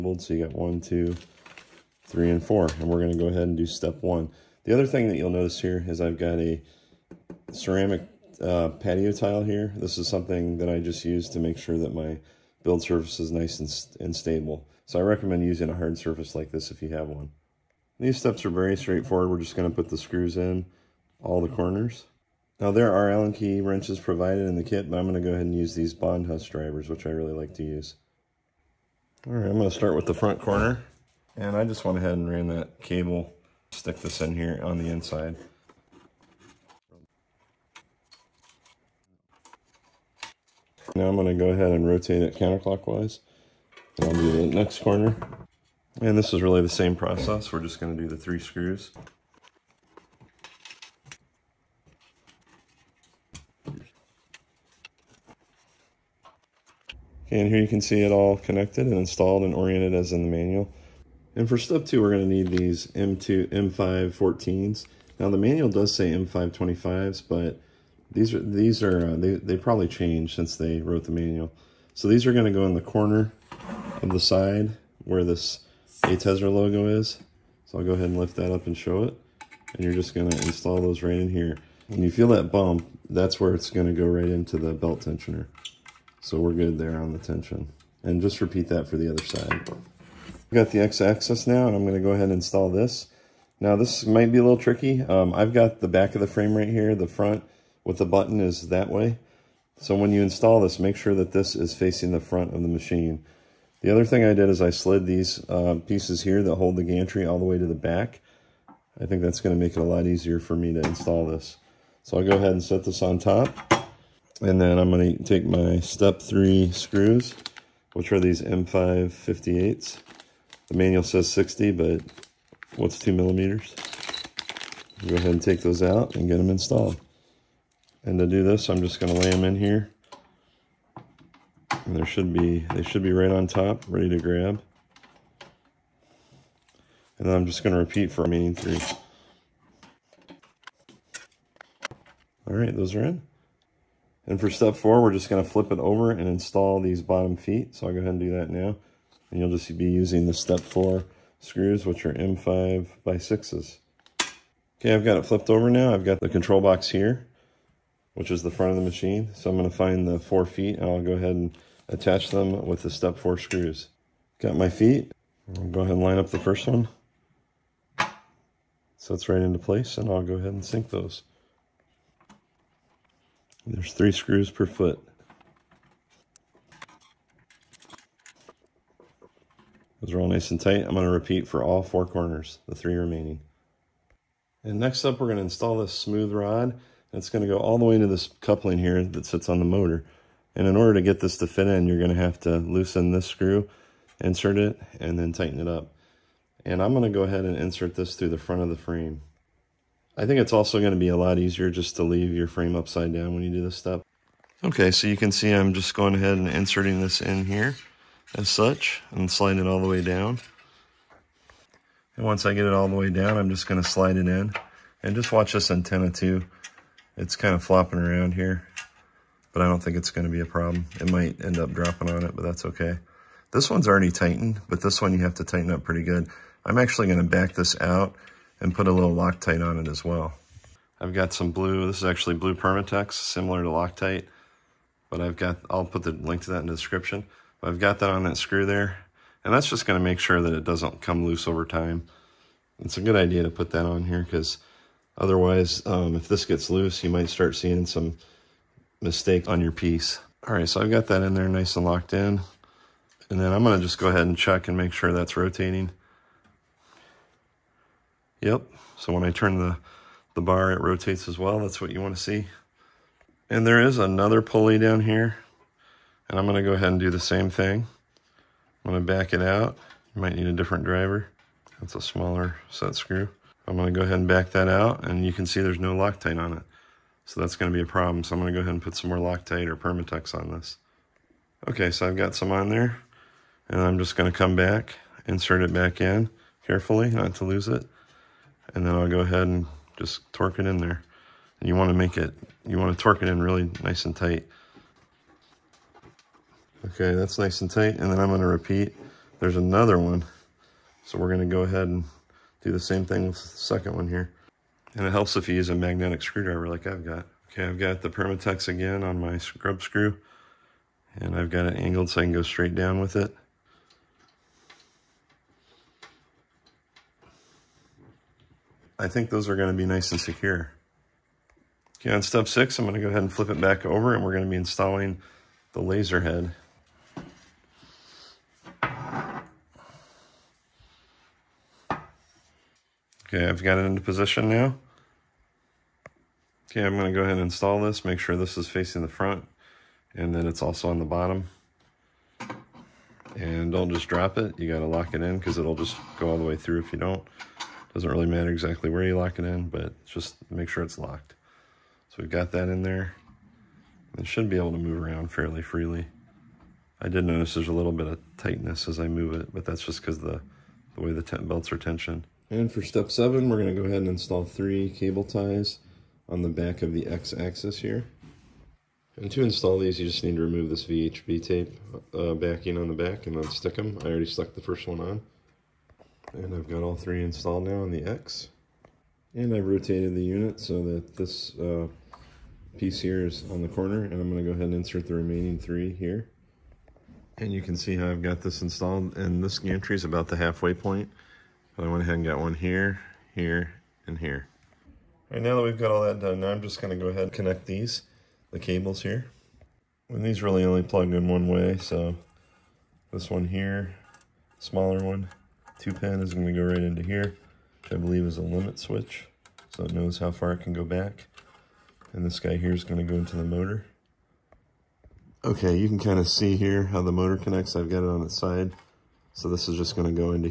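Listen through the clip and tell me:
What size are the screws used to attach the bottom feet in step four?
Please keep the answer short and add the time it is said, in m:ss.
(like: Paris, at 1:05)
M5 by 6, at 2:32.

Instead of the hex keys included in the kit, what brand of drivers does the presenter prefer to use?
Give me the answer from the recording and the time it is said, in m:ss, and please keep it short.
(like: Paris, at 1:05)
Bond, at 0:25.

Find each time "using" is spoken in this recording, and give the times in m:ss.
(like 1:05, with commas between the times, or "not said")
0:15, 2:29.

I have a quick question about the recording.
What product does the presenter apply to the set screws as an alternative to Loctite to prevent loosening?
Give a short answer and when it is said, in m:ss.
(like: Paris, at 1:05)
blue Permatex, at 3:52.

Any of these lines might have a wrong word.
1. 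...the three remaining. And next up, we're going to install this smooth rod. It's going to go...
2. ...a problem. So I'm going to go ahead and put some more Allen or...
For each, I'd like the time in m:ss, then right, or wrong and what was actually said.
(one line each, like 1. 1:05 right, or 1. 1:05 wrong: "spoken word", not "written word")
1. 3:02 right
2. 4:37 wrong: "Loctite", not "Allen".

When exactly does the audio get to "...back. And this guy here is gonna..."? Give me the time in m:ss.
6:50.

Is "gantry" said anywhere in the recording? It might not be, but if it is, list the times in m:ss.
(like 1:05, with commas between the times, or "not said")
1:46, 6:29.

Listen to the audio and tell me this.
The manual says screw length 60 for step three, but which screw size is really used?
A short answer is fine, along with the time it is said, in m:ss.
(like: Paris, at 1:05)
M558, at 1:58.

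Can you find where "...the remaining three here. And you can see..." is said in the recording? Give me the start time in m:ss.
6:25.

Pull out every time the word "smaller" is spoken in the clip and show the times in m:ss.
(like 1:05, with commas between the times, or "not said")
4:32, 6:44.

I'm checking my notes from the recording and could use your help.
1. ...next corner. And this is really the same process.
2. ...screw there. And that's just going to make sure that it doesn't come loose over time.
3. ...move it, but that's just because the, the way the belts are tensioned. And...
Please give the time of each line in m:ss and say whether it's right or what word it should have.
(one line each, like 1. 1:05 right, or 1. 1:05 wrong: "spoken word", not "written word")
1. 0:44 right
2. 3:58 right
3. 5:59 right.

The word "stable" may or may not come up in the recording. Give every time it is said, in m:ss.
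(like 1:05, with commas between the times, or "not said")
0:14.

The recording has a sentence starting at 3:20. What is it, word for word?
I think it's also going to be a lot easier just to leave your frame upside down when you do this step.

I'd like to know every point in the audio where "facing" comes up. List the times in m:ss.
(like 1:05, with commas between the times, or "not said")
1:41, 5:38.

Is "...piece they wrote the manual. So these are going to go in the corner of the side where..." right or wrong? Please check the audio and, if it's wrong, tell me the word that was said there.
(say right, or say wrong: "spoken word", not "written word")
wrong: "since", not "piece".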